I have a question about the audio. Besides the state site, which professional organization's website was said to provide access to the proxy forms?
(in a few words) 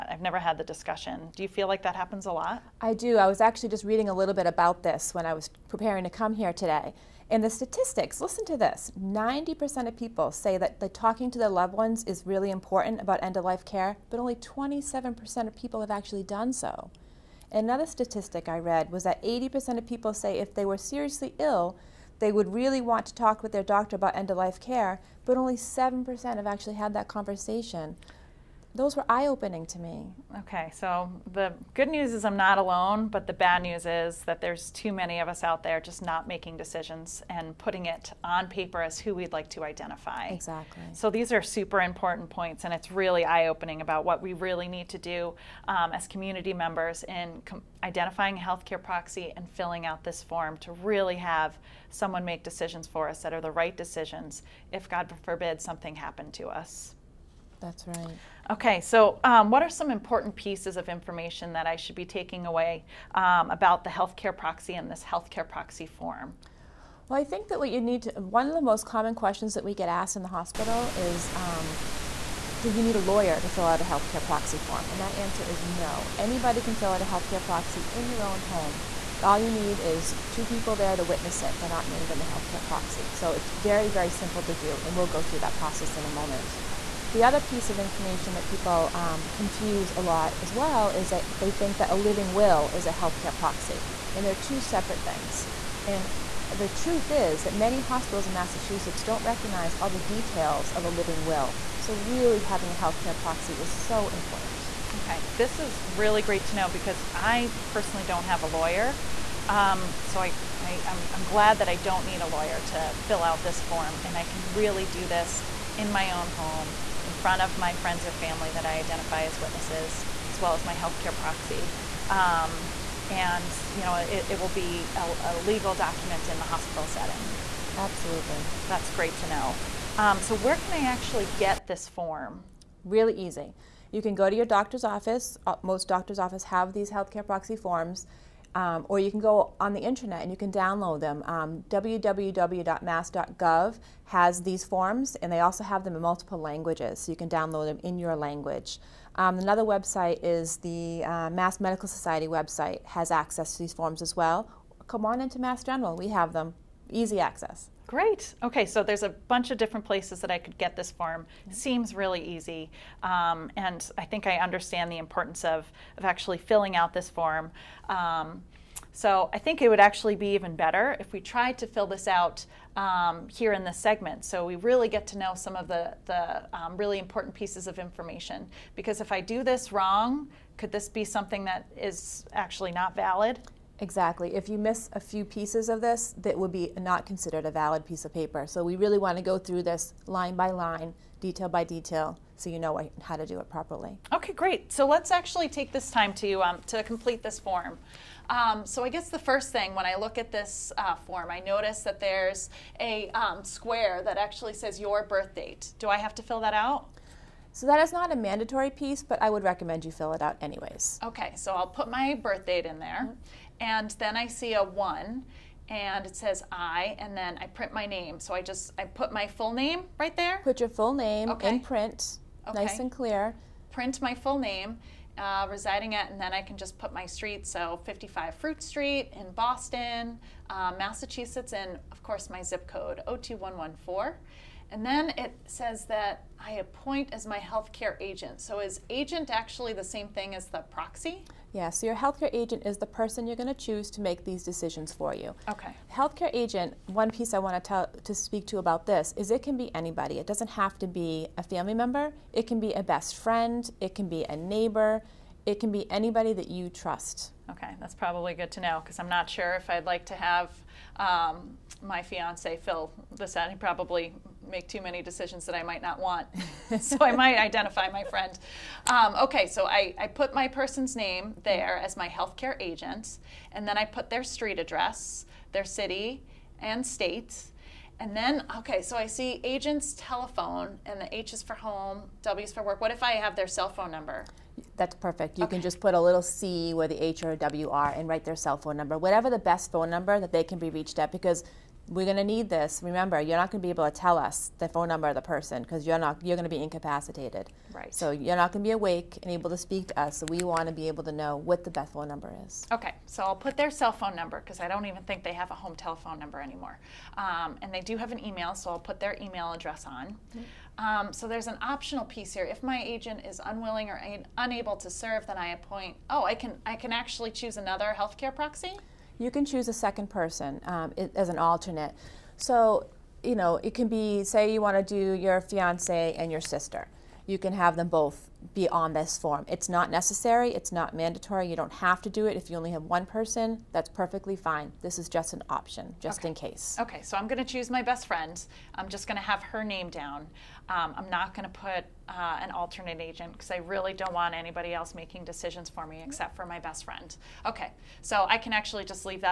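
Mass Medical Society.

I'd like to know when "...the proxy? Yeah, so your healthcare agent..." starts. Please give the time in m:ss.
4:00.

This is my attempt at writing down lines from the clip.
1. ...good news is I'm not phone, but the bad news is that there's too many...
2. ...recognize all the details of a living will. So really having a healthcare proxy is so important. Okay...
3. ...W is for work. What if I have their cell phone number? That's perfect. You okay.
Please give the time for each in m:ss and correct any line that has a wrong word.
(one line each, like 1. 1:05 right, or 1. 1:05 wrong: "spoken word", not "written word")
1. 0:31 wrong: "alone", not "phone"
2. 1:39 right
3. 4:42 right.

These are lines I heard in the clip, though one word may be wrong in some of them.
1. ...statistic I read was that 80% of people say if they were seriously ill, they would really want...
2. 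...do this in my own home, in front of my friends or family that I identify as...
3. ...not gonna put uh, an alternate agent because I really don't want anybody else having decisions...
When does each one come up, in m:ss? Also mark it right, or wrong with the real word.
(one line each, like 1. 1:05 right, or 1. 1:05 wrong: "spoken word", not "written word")
1. 0:17 right
2. 1:54 right
3. 5:41 wrong: "making", not "having".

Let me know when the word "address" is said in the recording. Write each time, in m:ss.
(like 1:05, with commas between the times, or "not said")
4:34, 5:09.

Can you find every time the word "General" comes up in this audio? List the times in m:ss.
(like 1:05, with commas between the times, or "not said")
2:35.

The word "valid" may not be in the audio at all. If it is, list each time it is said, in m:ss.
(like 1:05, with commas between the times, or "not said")
3:02, 3:07.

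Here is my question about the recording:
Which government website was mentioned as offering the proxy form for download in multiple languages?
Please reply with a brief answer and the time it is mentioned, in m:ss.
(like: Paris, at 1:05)
www.mass.gov, at 2:21.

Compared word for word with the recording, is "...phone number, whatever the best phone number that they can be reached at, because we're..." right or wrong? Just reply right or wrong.
right.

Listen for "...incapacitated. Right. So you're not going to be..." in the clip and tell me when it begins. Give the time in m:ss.
4:56.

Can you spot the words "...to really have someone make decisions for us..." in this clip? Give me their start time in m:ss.
0:50.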